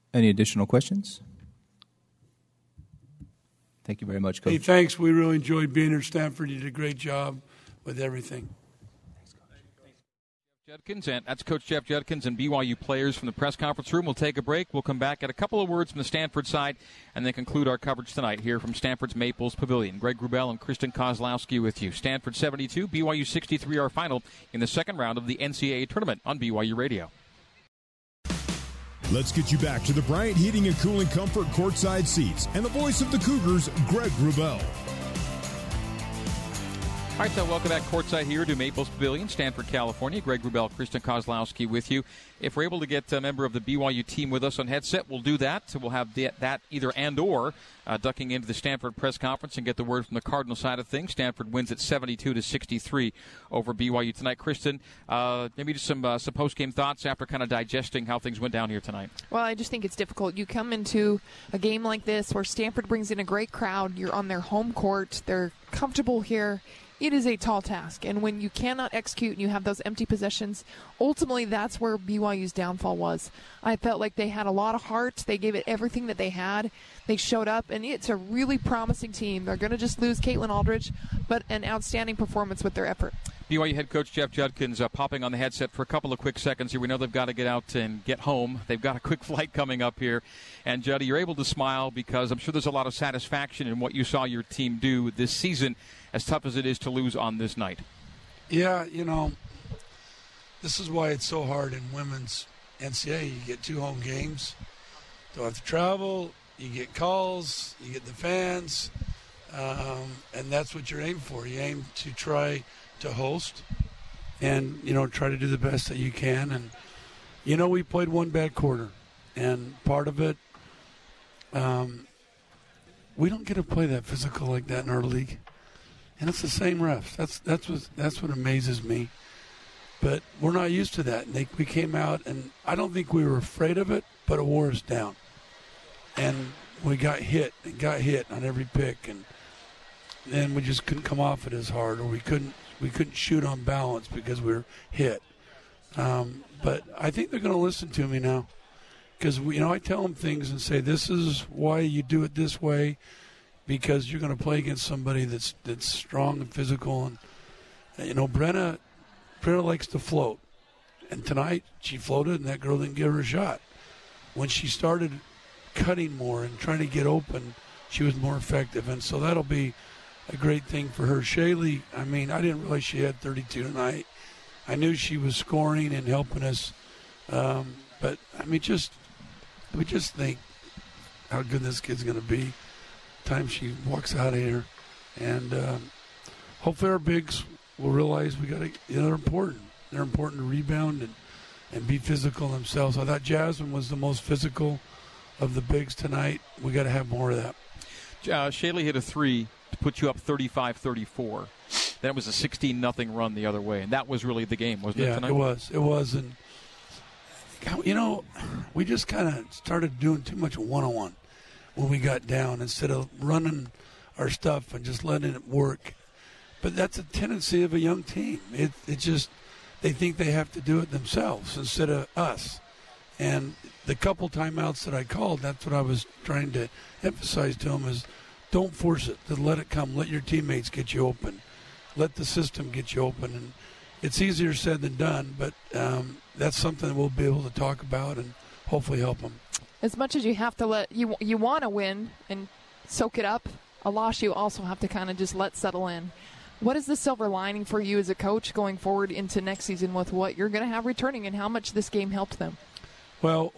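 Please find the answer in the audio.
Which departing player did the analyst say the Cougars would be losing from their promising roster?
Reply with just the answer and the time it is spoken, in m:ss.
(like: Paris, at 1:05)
Caitlin Alldredge, at 1:20.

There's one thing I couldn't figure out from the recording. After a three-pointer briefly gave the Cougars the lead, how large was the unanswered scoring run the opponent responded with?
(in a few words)
16-0.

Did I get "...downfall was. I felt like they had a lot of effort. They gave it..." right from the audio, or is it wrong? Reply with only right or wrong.
wrong.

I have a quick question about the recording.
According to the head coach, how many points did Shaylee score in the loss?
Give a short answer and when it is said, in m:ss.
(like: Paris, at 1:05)
32, at 2:53.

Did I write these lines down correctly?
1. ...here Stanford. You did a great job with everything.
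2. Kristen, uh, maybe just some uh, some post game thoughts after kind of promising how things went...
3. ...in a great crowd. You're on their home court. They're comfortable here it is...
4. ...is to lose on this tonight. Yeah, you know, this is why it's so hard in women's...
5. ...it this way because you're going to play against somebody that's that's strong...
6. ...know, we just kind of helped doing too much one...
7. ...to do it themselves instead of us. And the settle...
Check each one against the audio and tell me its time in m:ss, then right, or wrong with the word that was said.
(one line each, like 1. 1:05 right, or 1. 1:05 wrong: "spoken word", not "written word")
1. 0:05 right
2. 0:54 wrong: "digesting", not "promising"
3. 1:03 right
4. 1:36 wrong: "night", not "tonight"
5. 2:32 right
6. 3:27 wrong: "started", not "helped"
7. 3:40 wrong: "couple", not "settle".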